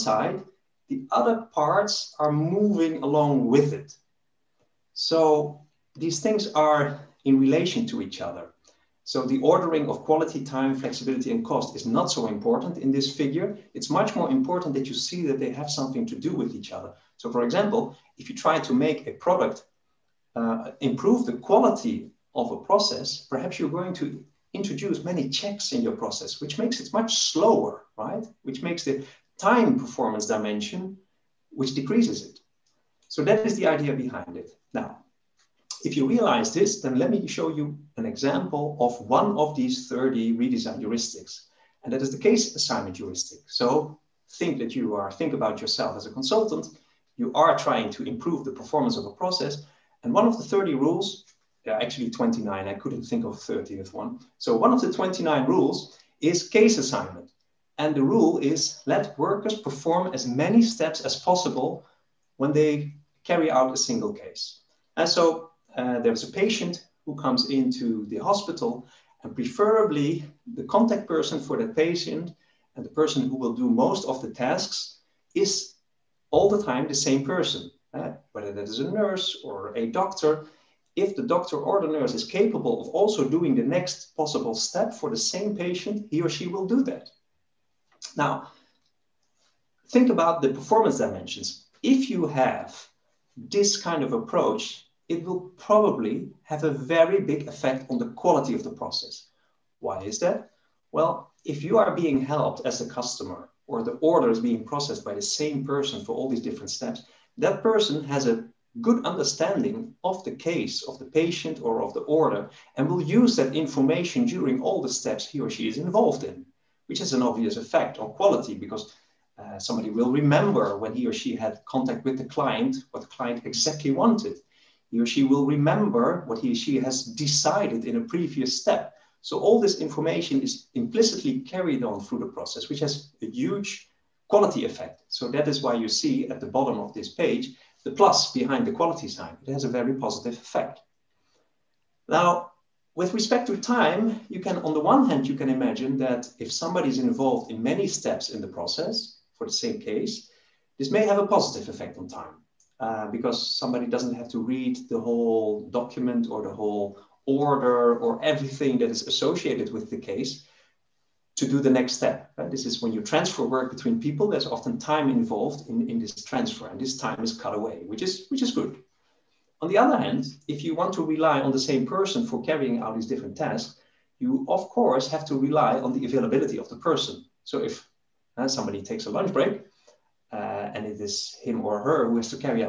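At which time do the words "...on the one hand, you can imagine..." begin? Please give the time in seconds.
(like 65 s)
144 s.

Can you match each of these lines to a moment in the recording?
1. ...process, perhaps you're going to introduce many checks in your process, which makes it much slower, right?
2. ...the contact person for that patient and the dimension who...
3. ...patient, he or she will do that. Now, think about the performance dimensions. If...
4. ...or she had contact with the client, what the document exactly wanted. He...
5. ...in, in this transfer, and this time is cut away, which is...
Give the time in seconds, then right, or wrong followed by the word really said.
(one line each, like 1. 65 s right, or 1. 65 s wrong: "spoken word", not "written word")
1. 22 s right
2. 70 s wrong: "person", not "dimension"
3. 85 s right
4. 121 s wrong: "client", not "document"
5. 165 s right.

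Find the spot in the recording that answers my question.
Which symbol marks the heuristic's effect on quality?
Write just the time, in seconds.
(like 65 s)
137 s.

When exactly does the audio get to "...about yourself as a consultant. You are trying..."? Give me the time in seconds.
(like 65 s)
45 s.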